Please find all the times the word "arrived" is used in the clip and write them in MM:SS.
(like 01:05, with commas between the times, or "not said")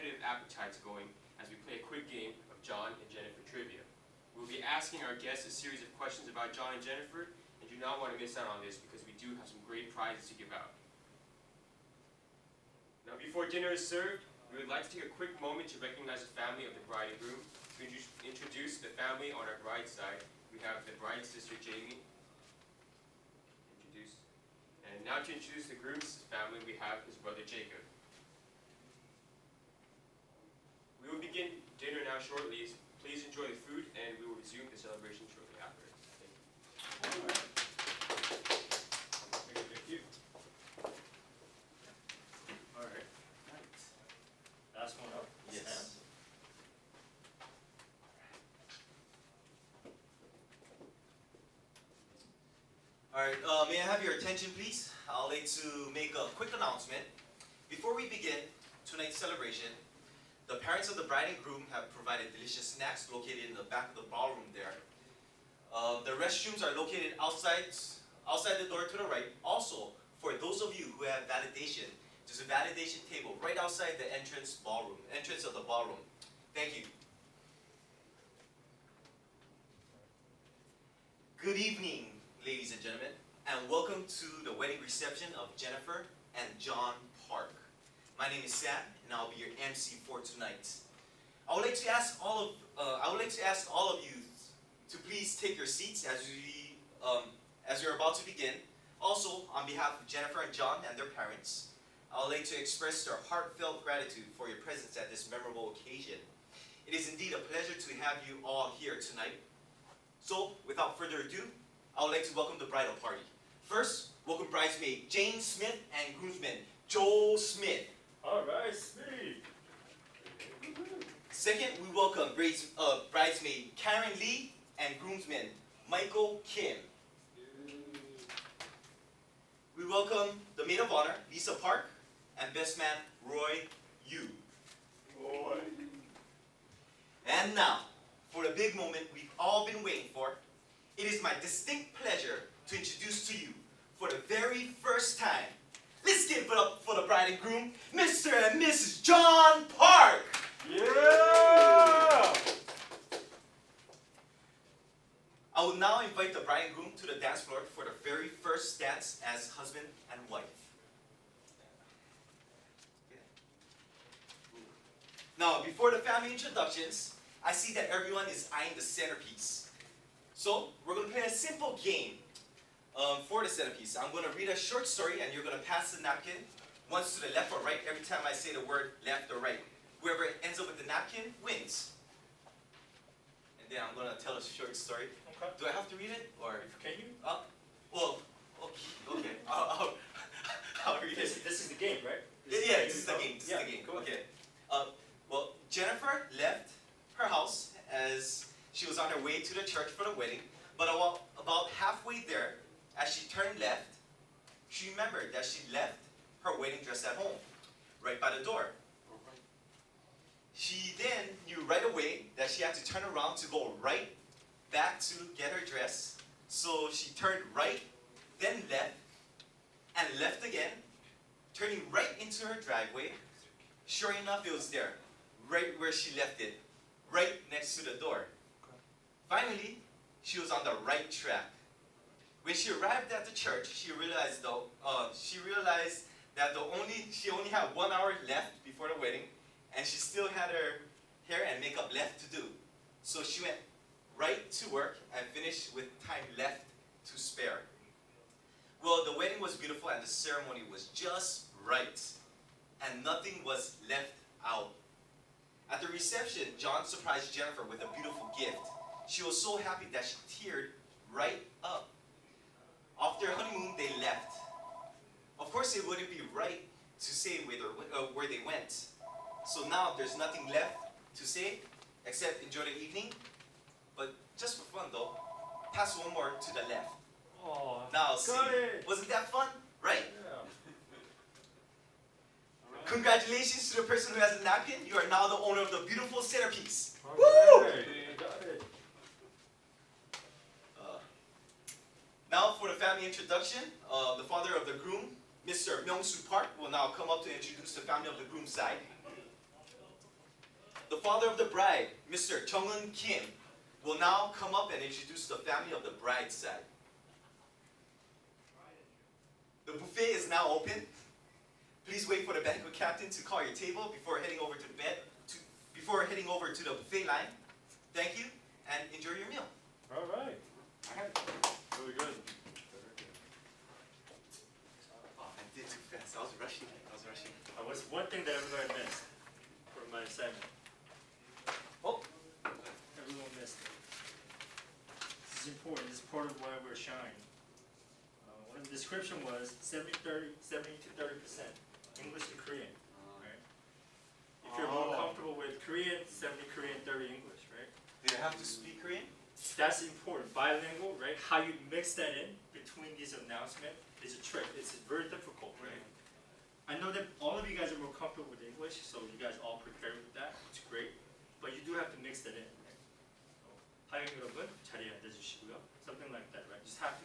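03:52.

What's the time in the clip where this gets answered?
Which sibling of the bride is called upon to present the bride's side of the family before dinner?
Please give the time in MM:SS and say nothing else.
00:21.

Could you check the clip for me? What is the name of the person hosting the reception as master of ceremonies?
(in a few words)
Sam.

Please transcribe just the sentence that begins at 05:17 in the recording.
Thank you, and enjoy your meal.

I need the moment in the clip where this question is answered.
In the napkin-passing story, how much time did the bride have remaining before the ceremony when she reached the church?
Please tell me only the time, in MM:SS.
03:57.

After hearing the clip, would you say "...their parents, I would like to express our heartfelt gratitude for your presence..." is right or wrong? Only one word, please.
right.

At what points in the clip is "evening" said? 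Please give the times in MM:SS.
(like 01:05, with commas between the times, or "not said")
01:21, 04:32.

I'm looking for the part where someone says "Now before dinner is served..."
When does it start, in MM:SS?
00:13.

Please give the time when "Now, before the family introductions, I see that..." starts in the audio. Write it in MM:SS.
02:45.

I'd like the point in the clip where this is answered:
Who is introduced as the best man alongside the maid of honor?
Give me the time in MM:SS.
02:13.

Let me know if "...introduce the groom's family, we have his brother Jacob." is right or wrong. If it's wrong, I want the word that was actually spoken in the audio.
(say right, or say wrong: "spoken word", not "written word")
right.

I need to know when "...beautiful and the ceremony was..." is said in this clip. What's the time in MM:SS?
04:09.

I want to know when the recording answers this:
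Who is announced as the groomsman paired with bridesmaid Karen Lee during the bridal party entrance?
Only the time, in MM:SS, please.
02:05.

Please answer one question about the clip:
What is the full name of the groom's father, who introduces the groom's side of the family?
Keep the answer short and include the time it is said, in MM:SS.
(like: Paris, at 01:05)
Myung-Soo Park, at 04:55.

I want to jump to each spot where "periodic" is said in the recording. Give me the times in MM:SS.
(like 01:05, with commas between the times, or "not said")
not said.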